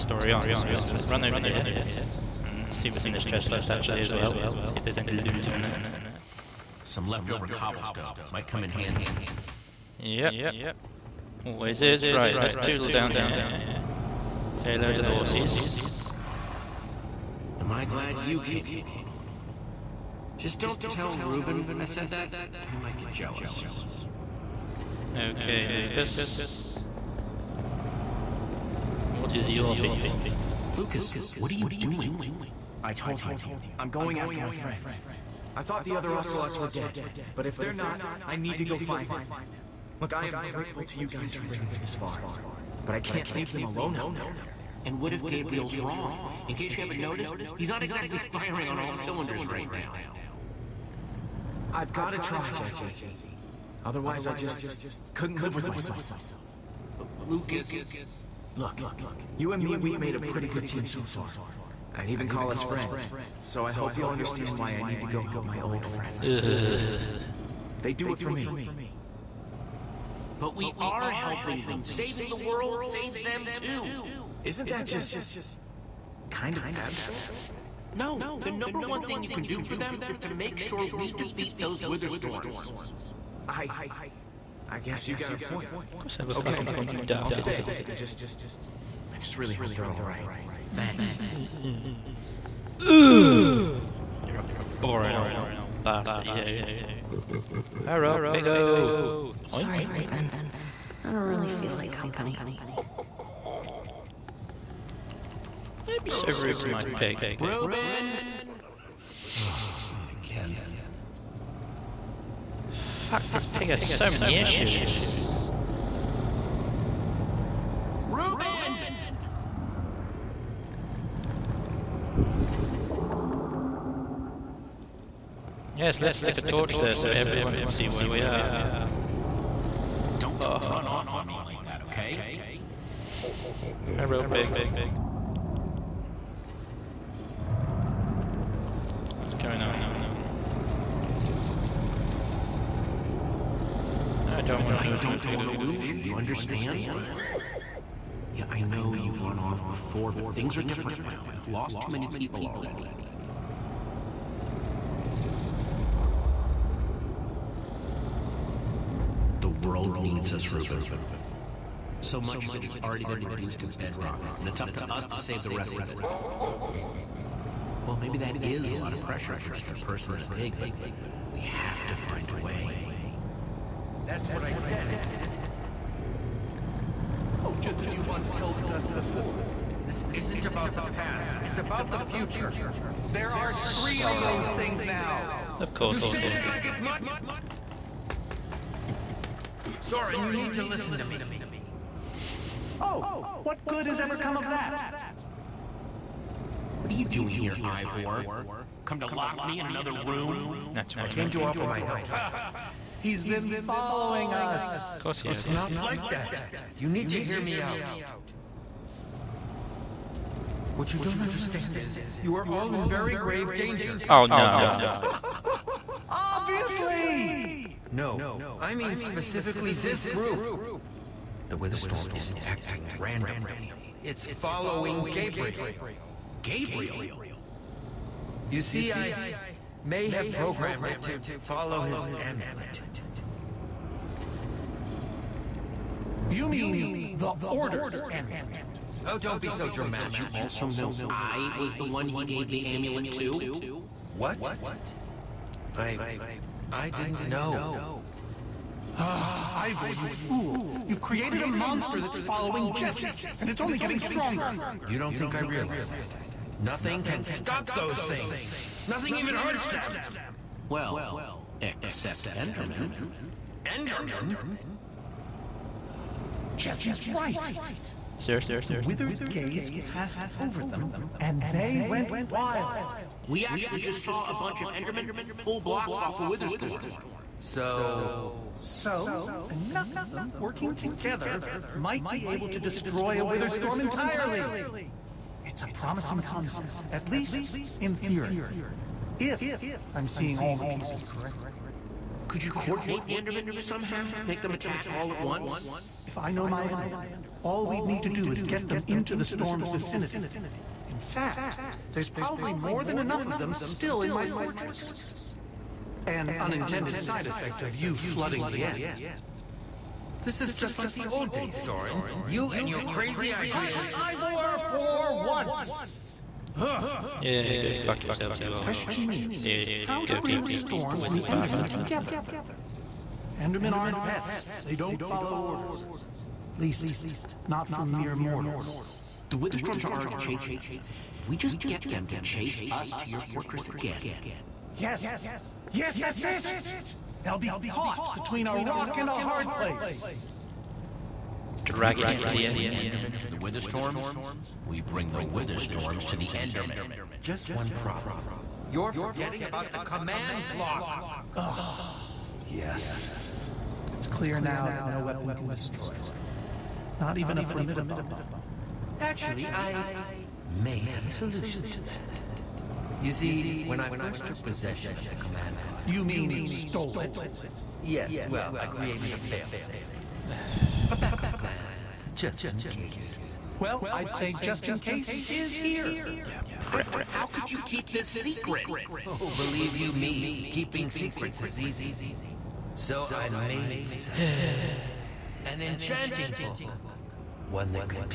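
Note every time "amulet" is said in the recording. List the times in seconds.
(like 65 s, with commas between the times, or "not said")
232 s, 238 s, 242 s.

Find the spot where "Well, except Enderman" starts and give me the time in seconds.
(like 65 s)
260 s.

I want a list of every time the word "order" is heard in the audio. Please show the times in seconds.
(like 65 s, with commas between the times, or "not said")
237 s, 325 s.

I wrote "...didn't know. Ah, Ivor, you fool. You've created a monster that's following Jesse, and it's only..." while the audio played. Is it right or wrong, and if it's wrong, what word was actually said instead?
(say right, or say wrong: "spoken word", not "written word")
right.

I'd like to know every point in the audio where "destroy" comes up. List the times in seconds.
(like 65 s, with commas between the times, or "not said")
282 s, 355 s.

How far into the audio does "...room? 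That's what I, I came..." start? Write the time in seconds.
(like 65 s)
199 s.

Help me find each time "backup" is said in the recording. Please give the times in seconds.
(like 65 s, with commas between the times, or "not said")
370 s.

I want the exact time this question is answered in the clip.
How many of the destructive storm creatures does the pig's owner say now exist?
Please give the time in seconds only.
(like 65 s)
183 s.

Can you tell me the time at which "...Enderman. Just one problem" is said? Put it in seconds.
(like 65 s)
346 s.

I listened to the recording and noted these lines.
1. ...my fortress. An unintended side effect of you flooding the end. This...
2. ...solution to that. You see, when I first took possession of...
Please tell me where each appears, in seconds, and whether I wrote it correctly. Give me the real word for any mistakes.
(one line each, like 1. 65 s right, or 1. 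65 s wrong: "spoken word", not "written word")
1. 304 s right
2. 361 s right.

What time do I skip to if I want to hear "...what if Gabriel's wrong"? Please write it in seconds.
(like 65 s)
45 s.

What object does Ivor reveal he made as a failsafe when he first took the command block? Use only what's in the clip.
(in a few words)
An enchanting book.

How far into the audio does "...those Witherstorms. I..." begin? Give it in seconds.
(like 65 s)
81 s.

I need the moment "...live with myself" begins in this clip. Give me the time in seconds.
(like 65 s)
55 s.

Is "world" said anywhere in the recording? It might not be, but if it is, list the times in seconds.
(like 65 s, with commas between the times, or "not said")
72 s, 159 s.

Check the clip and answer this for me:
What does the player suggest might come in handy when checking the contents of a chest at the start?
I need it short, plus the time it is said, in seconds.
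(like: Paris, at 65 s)
Leftover cobblestone, at 7 s.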